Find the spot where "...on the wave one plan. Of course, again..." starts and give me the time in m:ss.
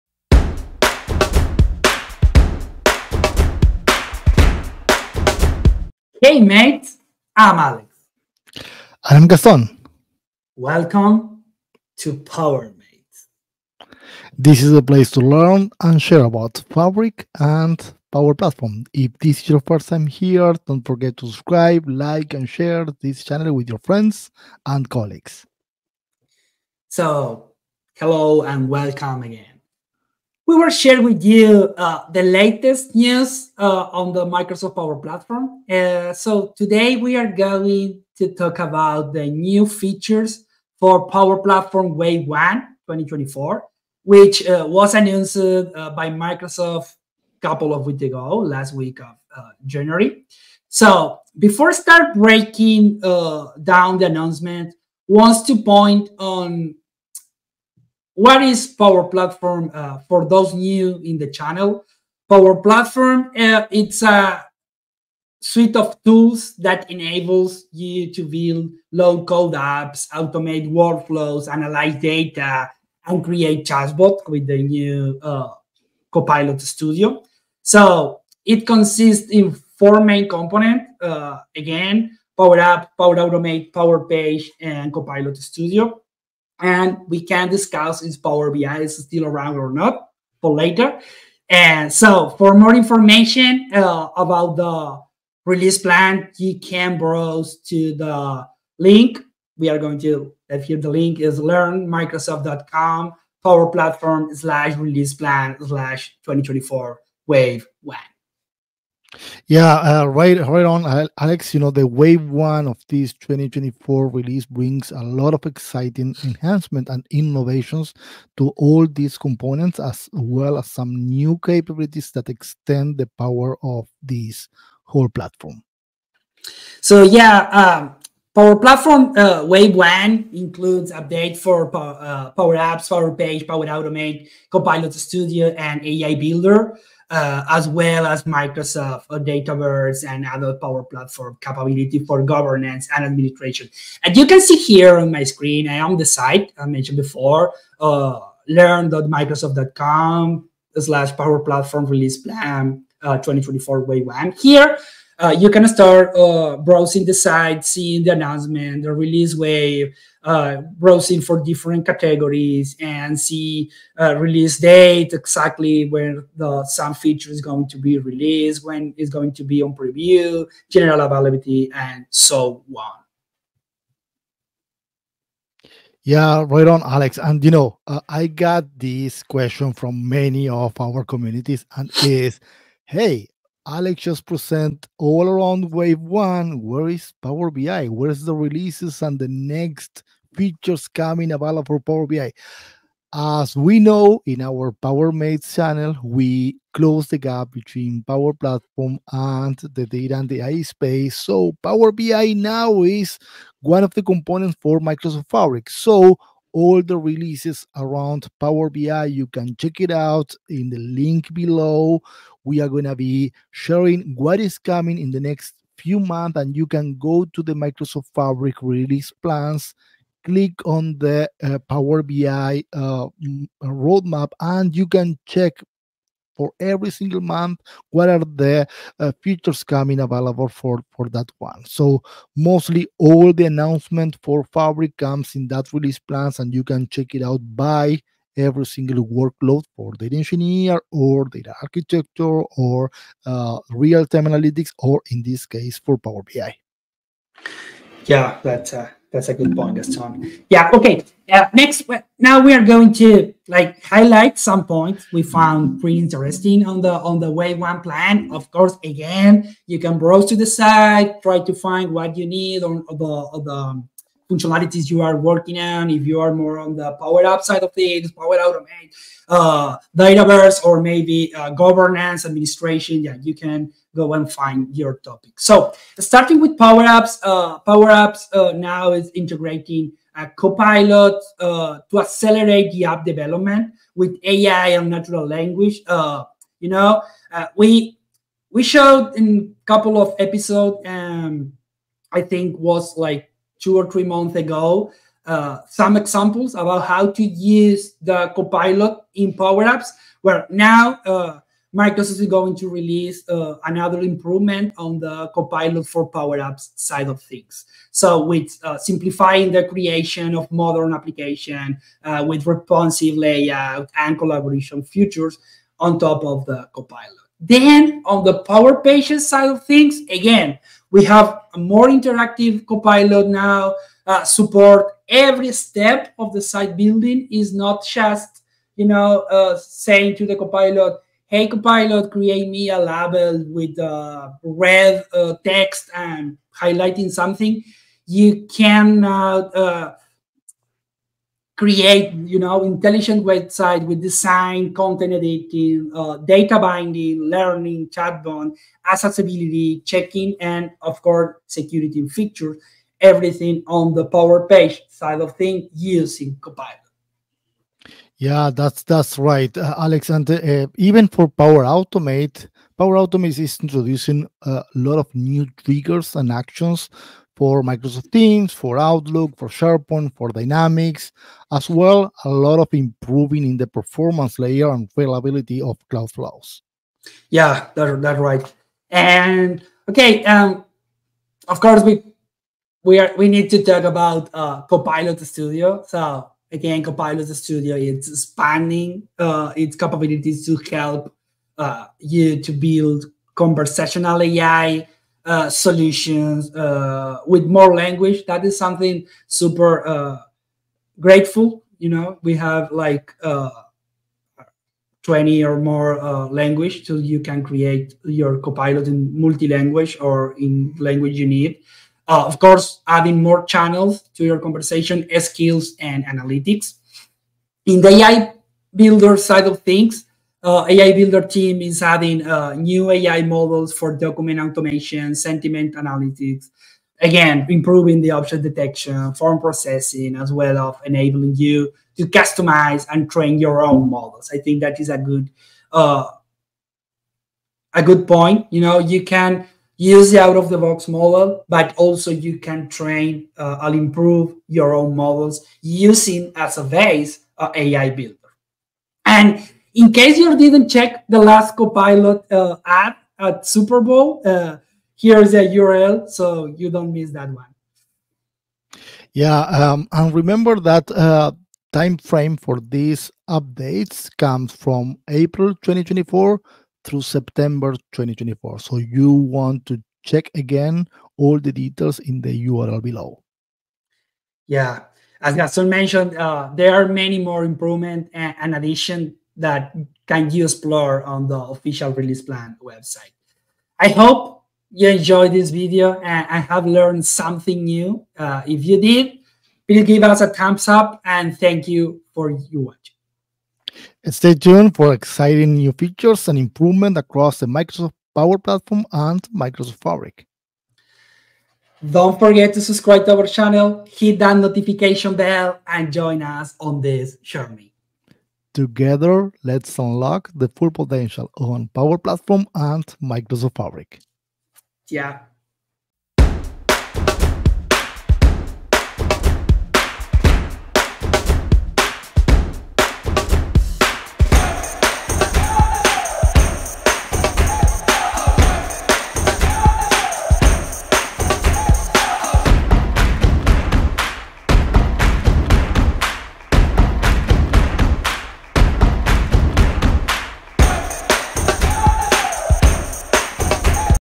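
4:17.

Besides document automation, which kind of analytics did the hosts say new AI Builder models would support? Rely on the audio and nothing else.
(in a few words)
sentiment analytics.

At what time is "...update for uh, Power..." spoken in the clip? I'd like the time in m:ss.
2:10.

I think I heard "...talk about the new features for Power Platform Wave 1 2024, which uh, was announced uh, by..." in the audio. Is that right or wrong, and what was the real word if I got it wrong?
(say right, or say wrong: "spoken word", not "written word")
right.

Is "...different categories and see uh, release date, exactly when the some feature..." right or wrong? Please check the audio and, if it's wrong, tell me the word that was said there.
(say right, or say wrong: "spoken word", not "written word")
right.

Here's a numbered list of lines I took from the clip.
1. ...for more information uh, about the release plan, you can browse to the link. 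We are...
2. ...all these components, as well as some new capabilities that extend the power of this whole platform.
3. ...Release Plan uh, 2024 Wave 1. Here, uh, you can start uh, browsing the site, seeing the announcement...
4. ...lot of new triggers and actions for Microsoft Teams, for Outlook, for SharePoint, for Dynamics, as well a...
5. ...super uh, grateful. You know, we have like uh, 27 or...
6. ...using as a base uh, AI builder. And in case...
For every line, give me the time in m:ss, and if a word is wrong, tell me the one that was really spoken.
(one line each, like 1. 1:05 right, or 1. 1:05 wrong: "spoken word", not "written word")
1. 1:32 right
2. 1:58 right
3. 2:31 right
4. 6:04 right
5. 6:39 wrong: "20", not "27"
6. 7:25 right.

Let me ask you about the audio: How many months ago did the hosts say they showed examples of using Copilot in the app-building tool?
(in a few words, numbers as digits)
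two or three months.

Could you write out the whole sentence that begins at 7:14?
I think that is a good, uh, a good point.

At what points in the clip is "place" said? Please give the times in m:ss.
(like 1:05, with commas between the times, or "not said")
0:14.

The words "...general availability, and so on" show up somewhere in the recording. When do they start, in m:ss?
2:50.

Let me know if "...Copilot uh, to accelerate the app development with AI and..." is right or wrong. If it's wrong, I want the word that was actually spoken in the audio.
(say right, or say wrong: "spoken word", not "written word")
right.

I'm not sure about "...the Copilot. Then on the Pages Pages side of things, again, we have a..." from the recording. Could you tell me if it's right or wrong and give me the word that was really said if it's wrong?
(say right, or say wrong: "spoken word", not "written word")
wrong: "Power", not "Pages".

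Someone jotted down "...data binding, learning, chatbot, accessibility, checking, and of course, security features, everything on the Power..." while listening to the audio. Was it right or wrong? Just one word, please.
right.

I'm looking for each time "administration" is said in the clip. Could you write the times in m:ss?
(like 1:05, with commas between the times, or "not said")
2:23, 4:32.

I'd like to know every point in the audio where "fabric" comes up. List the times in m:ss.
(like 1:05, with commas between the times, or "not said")
0:16, 3:25, 3:38, 3:54, 8:19, 8:33.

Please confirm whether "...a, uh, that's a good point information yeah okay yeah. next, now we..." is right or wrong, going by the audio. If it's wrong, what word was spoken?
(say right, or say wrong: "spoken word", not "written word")
wrong: "gaston", not "information".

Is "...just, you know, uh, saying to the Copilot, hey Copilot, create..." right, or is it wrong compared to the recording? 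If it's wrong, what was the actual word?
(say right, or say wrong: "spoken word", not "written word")
right.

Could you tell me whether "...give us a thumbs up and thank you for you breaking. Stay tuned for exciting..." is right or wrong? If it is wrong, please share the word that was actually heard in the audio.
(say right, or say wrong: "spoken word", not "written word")
wrong: "watching", not "breaking".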